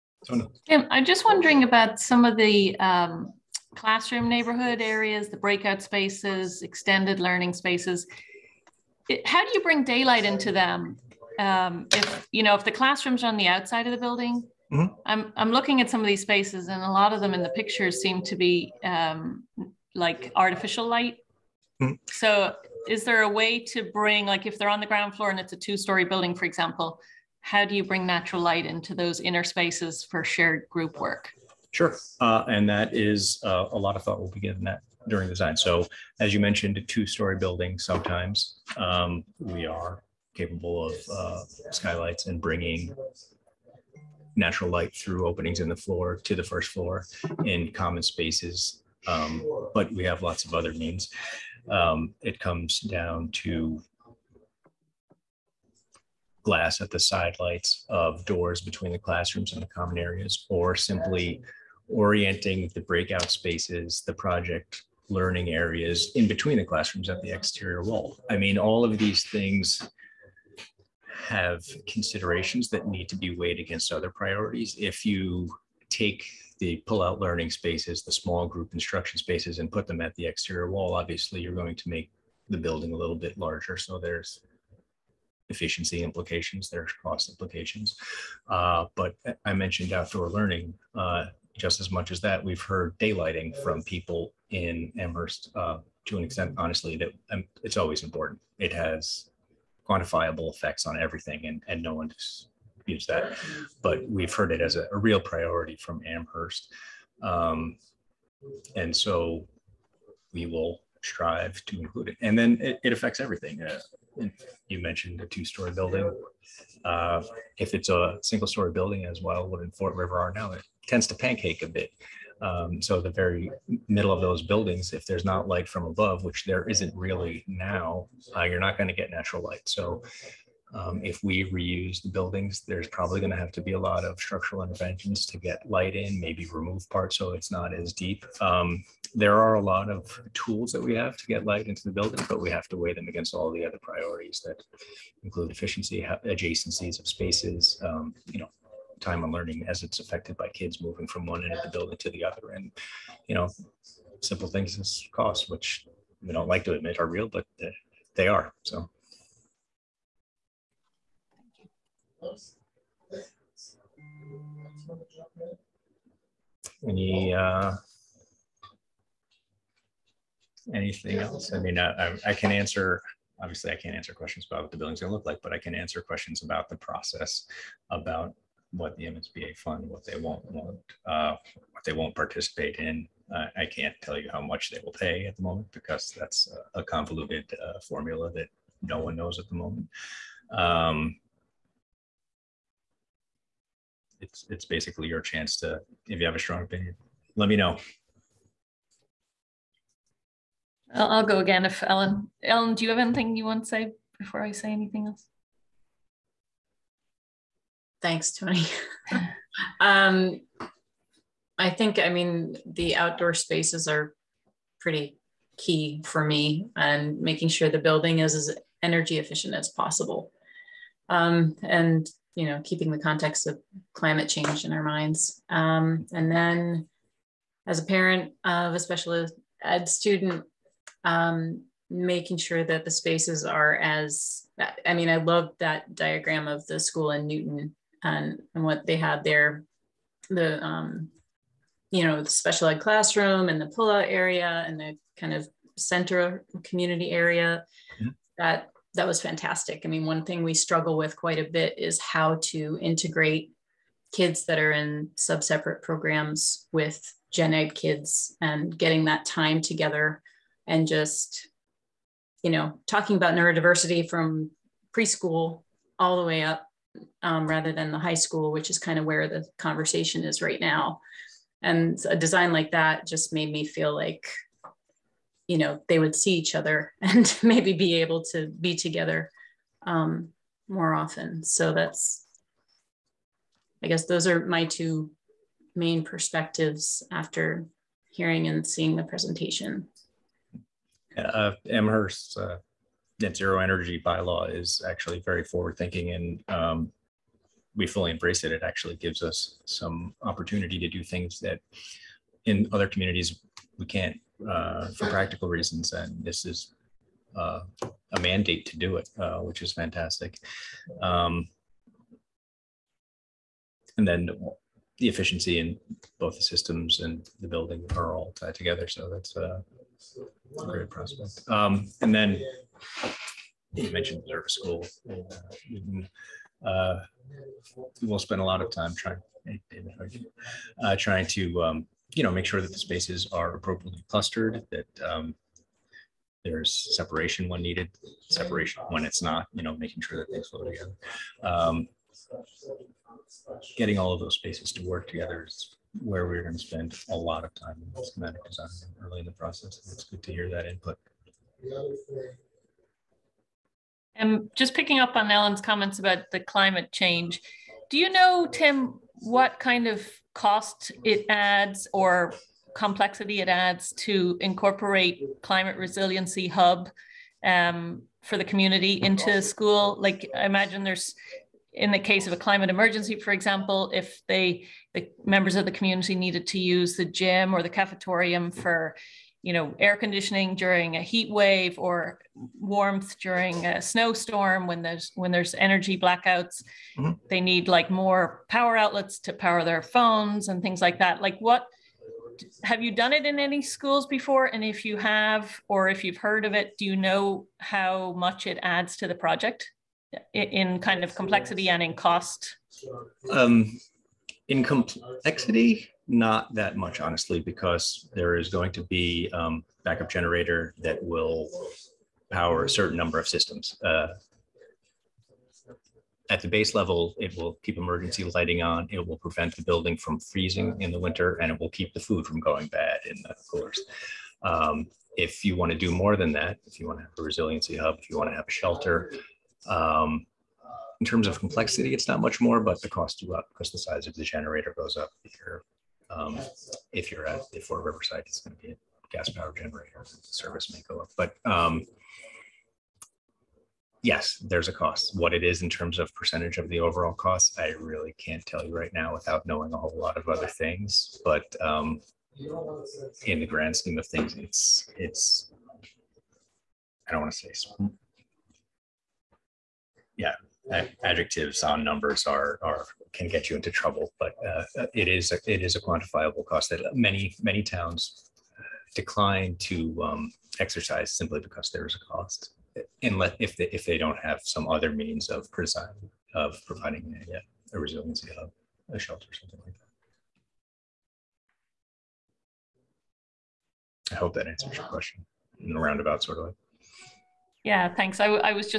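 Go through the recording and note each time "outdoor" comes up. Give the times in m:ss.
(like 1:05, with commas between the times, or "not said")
1:29, 3:32.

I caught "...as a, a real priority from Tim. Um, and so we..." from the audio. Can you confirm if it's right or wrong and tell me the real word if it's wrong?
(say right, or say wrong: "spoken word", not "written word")
wrong: "Amherst", not "Tim".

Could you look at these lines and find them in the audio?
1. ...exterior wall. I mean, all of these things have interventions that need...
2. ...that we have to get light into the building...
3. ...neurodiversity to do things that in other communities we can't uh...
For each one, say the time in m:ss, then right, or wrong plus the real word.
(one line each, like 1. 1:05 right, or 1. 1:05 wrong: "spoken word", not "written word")
1. 1:07 wrong: "considerations", not "interventions"
2. 2:20 right
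3. 5:00 wrong: "opportunity", not "neurodiversity".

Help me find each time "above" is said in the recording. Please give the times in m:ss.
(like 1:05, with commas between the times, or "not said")
2:05.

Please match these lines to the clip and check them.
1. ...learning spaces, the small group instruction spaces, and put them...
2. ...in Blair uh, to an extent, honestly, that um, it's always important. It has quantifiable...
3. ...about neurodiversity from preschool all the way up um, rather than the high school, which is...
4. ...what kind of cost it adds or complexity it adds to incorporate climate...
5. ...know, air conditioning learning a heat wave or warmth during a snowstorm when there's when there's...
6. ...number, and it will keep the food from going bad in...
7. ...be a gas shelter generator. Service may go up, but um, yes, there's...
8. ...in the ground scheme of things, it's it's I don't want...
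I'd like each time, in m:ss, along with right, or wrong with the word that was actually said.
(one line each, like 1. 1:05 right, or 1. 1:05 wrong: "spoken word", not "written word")
1. 1:17 right
2. 1:34 wrong: "Amherst", not "Blair"
3. 4:23 right
4. 5:59 right
5. 6:19 wrong: "during", not "learning"
6. 7:00 wrong: "winter", not "number"
7. 7:18 wrong: "power", not "shelter"
8. 7:33 wrong: "grand", not "ground".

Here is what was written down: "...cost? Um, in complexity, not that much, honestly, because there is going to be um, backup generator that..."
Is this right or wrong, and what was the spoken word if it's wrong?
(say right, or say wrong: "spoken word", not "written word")
right.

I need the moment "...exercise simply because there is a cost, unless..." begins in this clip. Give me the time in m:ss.
7:50.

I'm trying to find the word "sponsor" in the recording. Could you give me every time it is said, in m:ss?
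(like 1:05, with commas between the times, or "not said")
not said.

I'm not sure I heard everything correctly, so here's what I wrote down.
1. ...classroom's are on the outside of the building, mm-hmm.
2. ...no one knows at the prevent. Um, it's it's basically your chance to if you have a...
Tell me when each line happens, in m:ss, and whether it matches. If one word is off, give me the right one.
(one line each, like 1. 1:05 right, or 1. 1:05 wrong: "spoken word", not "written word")
1. 0:12 right
2. 3:08 wrong: "moment", not "prevent".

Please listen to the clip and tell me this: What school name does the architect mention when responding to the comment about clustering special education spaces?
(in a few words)
Blair School.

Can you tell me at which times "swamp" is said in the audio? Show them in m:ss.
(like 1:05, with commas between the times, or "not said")
not said.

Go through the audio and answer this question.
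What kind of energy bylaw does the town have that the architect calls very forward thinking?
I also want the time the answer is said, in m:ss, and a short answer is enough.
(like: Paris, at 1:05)
net zero energy, at 4:53.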